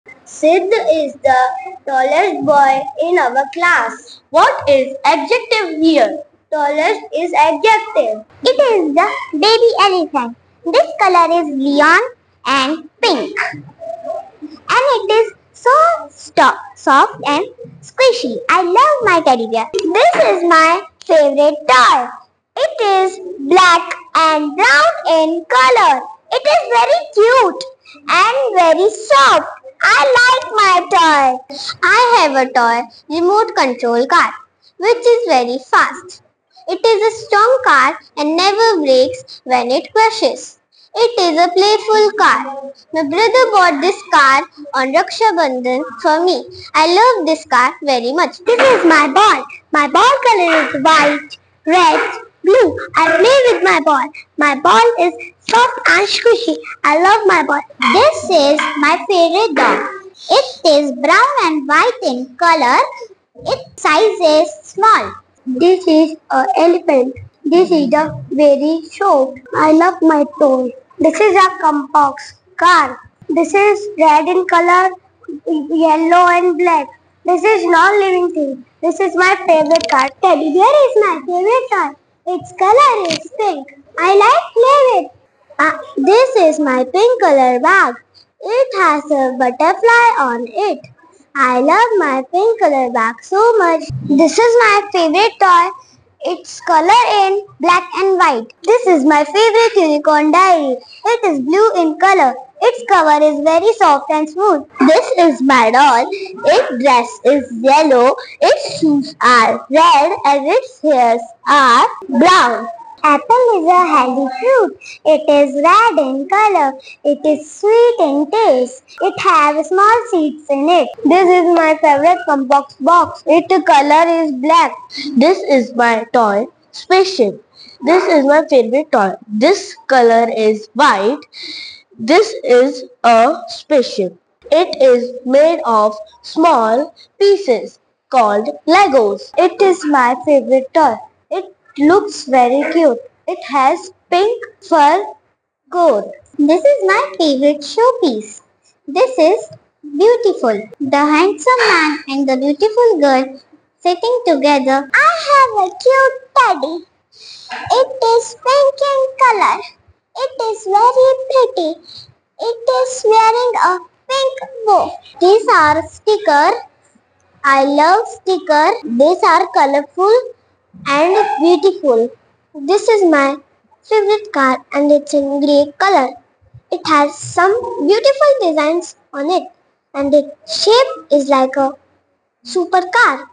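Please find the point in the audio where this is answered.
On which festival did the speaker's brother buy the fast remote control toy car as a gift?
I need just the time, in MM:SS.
00:44.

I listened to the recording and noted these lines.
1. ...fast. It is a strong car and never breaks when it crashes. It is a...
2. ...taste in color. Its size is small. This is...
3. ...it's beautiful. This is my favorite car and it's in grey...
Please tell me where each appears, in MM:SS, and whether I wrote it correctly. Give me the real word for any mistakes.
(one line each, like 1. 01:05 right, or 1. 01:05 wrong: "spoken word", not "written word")
1. 00:35 right
2. 01:01 wrong: "white", not "taste"
3. 02:51 right.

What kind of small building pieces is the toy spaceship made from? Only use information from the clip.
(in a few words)
Legos.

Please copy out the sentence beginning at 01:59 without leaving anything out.
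It has small seeds in it.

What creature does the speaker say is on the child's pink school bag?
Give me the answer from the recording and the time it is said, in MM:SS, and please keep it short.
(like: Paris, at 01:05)
Butterfly, at 01:29.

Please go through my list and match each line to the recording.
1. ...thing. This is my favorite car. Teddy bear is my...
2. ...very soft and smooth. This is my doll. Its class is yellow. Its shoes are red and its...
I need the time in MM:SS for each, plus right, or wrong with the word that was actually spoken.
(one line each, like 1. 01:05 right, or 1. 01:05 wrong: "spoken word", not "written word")
1. 01:18 right
2. 01:43 wrong: "dress", not "class".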